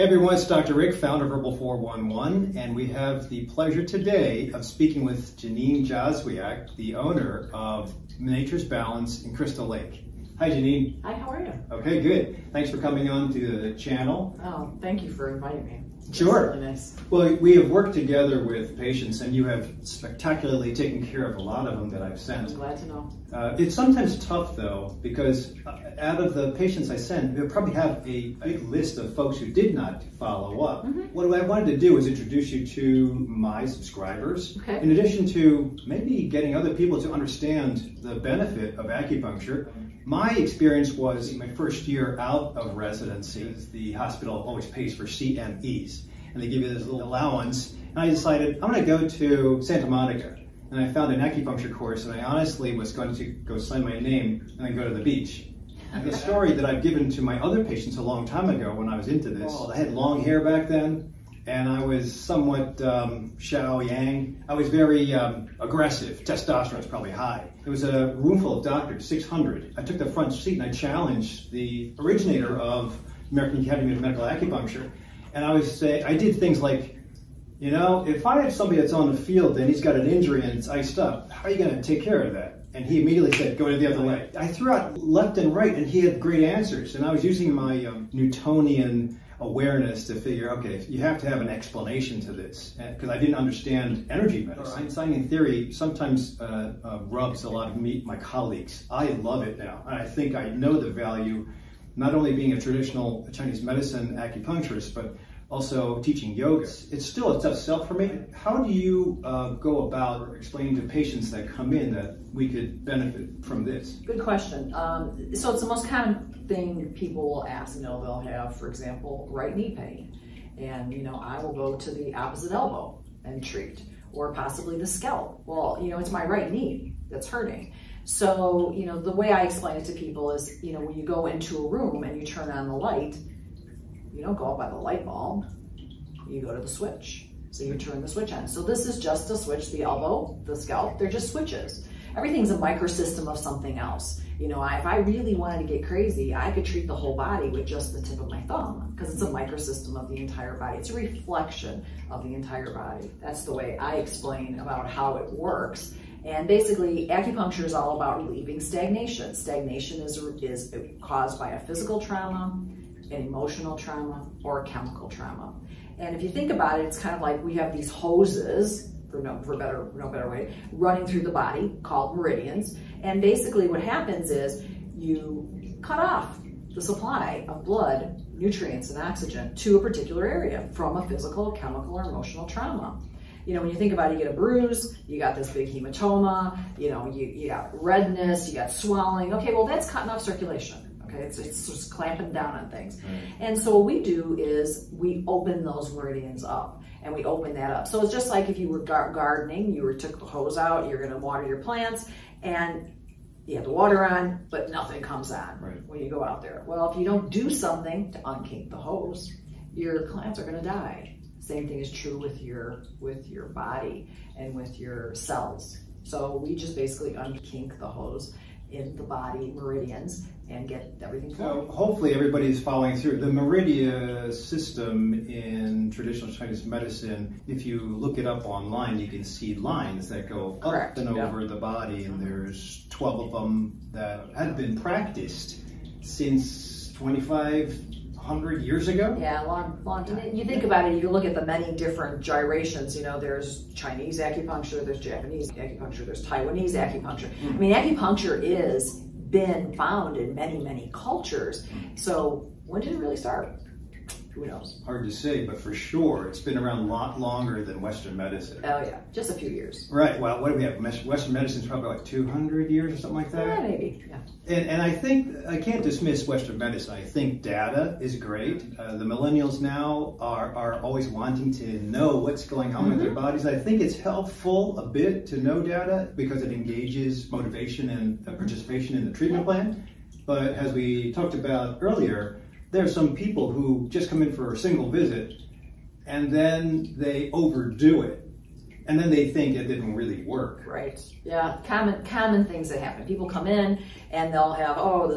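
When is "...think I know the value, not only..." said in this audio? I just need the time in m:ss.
1:40.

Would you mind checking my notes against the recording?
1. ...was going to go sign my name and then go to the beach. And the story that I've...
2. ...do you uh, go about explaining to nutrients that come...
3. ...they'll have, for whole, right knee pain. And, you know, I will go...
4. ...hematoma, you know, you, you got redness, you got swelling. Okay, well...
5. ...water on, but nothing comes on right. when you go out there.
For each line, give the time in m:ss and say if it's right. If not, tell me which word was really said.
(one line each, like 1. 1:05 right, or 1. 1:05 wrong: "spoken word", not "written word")
1. 0:52 right
2. 1:48 wrong: "patients", not "nutrients"
3. 1:58 wrong: "example", not "whole"
4. 3:05 right
5. 3:23 right.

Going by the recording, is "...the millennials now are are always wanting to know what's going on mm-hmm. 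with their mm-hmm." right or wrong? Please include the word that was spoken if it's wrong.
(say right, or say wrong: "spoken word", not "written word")
right.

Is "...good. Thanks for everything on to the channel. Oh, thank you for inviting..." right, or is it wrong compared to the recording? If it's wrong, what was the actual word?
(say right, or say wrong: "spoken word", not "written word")
wrong: "coming", not "everything".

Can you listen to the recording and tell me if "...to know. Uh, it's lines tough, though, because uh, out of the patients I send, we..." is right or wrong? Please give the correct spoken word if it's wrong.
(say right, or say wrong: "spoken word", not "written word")
wrong: "sometimes", not "lines".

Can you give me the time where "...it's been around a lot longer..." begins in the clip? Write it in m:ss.
4:16.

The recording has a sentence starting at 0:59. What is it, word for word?
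I had long hair back then, and I was somewhat um, Xiao Yang.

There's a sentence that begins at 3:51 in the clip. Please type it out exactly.
over the body and there's 12 of them that have been practiced since 25 100 years ago?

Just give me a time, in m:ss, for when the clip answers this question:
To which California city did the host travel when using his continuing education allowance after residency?
0:49.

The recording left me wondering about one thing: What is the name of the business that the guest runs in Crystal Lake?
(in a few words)
Nature's Balance.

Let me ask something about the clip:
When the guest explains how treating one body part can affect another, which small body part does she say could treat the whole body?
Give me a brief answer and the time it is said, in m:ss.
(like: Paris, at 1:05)
tip of my thumb, at 2:28.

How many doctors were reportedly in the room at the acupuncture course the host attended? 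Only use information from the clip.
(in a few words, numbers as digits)
600.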